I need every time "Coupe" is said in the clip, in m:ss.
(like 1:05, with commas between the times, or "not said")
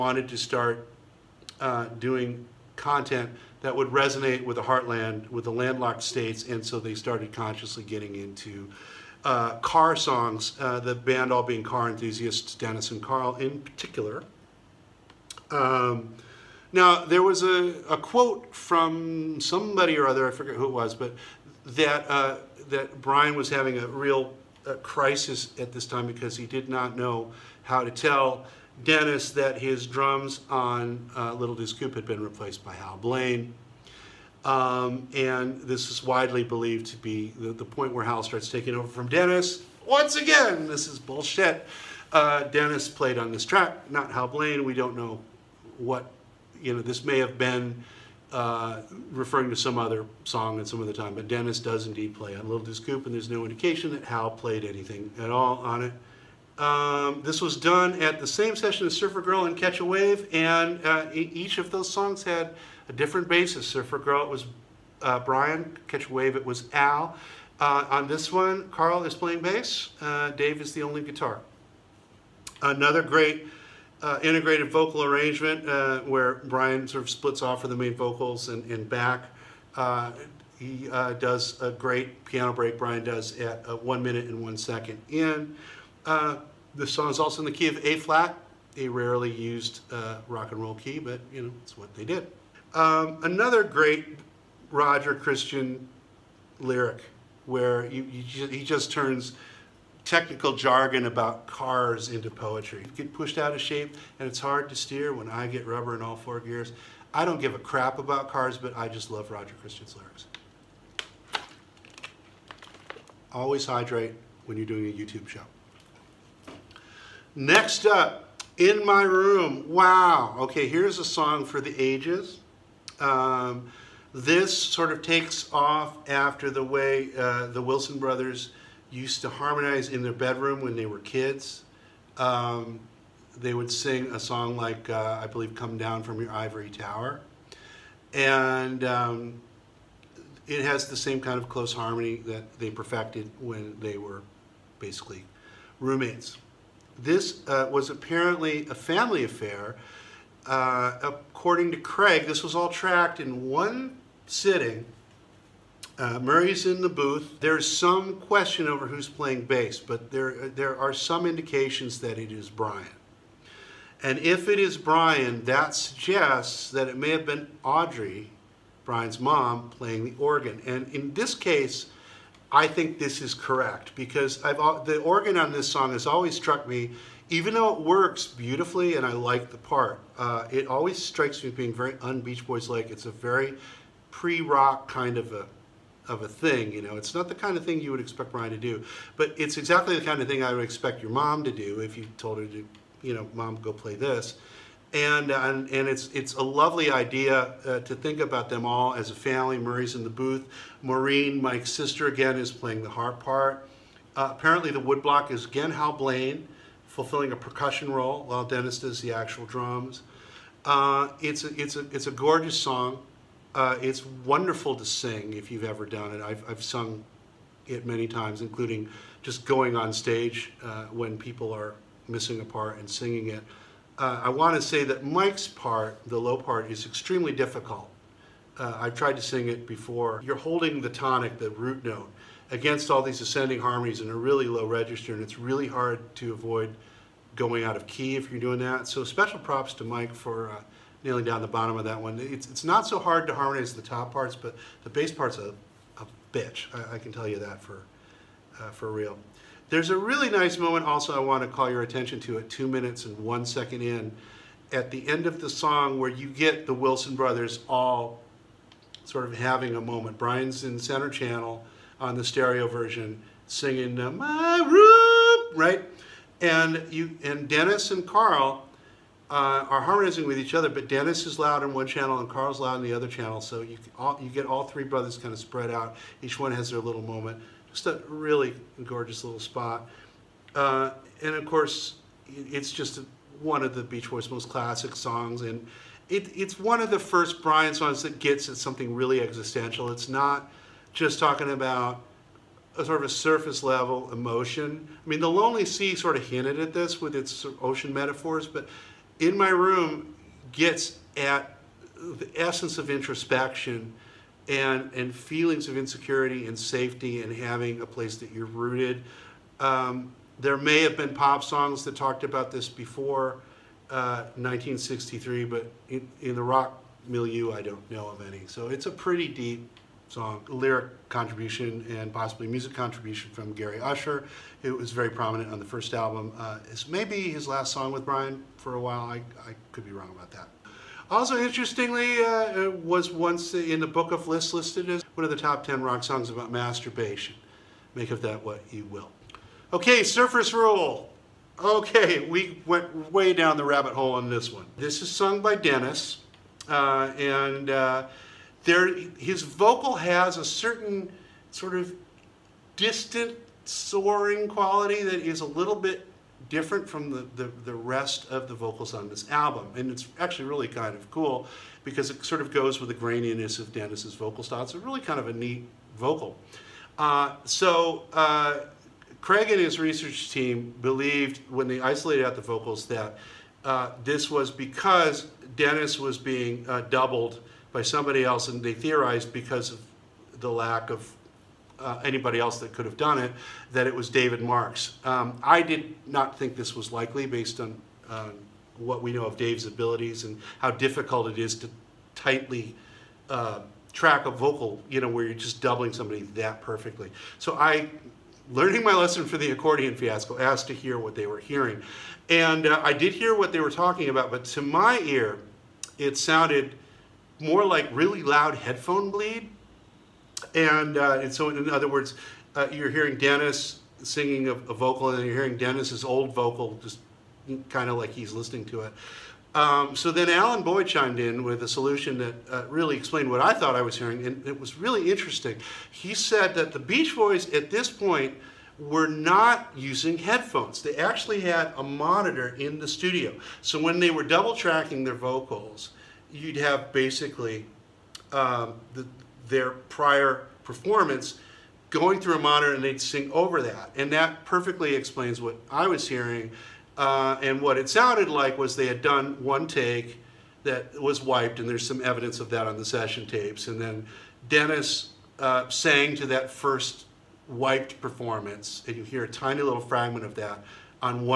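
0:31, 0:52.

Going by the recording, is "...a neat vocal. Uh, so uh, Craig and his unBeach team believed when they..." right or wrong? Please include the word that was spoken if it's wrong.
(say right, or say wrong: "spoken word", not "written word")
wrong: "research", not "unBeach".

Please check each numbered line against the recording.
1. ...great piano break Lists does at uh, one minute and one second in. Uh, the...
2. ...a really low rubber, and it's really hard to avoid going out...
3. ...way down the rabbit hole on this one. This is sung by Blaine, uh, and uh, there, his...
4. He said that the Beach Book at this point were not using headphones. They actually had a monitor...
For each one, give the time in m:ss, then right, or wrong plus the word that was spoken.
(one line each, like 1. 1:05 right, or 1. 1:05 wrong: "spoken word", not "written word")
1. 1:21 wrong: "Brian", not "Lists"
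2. 3:54 wrong: "register", not "rubber"
3. 5:43 wrong: "Dennis", not "Blaine"
4. 7:05 wrong: "Boys", not "Book".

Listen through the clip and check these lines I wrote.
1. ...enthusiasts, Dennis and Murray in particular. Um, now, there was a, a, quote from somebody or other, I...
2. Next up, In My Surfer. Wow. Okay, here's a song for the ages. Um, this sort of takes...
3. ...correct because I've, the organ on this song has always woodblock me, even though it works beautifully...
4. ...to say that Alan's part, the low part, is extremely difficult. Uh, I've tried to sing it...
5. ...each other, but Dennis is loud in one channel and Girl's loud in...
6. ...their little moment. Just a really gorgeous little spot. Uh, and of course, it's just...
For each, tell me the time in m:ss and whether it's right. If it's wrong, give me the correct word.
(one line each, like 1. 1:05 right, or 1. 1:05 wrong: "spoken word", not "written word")
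1. 0:11 wrong: "Carl", not "Murray"
2. 1:57 wrong: "Room", not "Surfer"
3. 2:53 wrong: "struck", not "woodblock"
4. 3:44 wrong: "Mike", not "Alan"
5. 4:30 wrong: "Carl", not "Girl"
6. 4:36 right.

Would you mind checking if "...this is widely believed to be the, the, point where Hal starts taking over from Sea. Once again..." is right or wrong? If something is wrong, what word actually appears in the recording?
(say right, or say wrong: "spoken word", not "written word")
wrong: "Dennis", not "Sea".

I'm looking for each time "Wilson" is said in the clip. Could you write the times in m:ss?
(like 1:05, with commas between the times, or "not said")
2:07, 4:16.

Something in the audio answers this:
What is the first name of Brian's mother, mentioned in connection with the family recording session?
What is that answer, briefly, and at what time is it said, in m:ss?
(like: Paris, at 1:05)
Audrey, at 2:47.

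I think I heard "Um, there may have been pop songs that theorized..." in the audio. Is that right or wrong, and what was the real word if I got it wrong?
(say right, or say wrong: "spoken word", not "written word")
wrong: "talked", not "theorized".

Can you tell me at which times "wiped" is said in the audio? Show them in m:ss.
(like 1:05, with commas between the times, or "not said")
7:31, 7:37.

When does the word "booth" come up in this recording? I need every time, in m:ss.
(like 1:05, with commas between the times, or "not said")
2:36, 3:20.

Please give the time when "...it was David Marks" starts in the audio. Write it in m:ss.
6:23.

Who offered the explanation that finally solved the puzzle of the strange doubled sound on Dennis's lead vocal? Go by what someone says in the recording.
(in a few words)
Alan Boyd.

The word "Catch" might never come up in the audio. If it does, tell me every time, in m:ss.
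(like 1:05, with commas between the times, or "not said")
0:59, 1:05.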